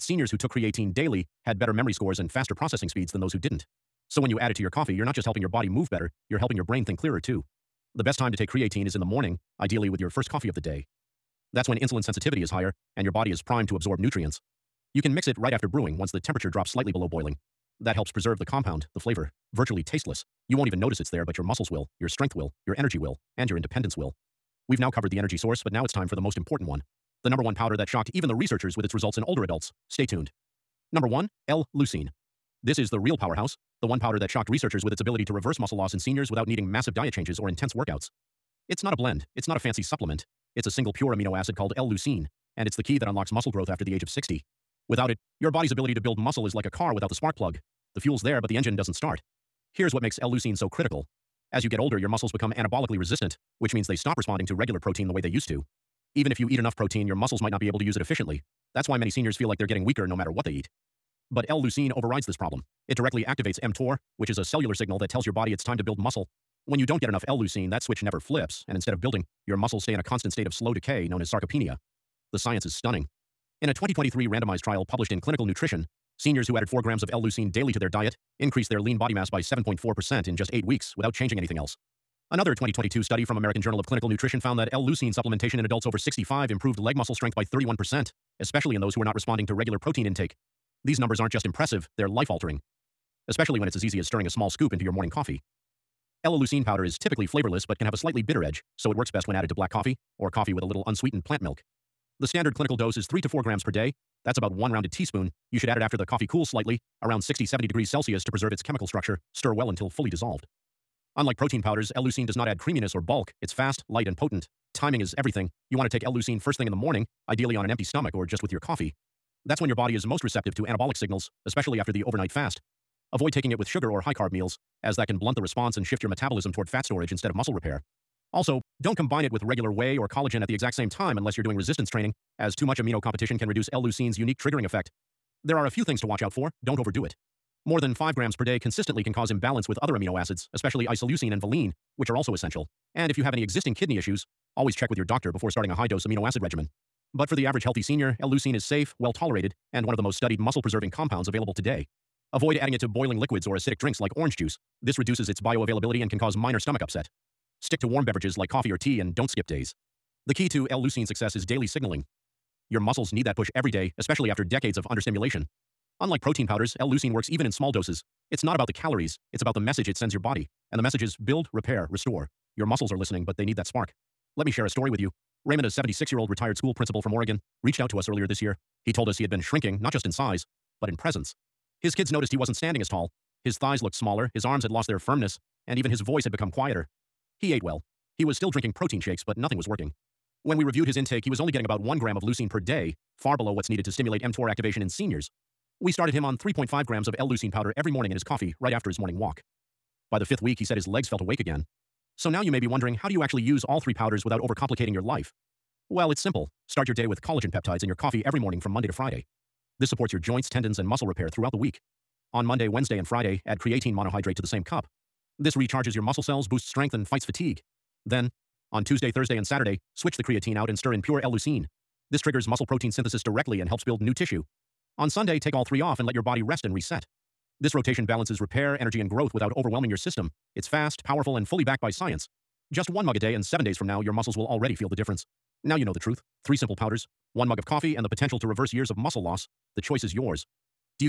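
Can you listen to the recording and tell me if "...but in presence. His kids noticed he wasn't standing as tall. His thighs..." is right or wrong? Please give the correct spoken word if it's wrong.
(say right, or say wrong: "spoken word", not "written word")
right.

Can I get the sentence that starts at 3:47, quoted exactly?
This rotation balances repair, energy, and growth without overwhelming your system.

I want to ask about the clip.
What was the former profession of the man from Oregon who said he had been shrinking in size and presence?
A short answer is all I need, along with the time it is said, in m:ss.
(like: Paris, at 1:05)
school principal, at 2:56.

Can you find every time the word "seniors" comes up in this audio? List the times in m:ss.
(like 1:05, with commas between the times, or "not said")
0:00, 0:35, 0:59, 1:16, 2:27, 3:14.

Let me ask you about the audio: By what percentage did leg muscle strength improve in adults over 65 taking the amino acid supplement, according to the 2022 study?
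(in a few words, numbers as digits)
31%.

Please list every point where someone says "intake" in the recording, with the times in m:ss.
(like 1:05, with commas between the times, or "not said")
1:30, 3:10.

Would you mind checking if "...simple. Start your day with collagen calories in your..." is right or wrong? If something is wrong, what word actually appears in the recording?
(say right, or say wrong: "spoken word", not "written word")
wrong: "peptides", not "calories".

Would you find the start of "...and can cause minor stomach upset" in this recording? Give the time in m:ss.
2:36.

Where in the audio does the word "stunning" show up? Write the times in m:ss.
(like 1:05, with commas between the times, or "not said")
1:12.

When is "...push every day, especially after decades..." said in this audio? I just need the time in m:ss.
2:43.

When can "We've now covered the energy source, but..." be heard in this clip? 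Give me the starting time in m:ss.
0:24.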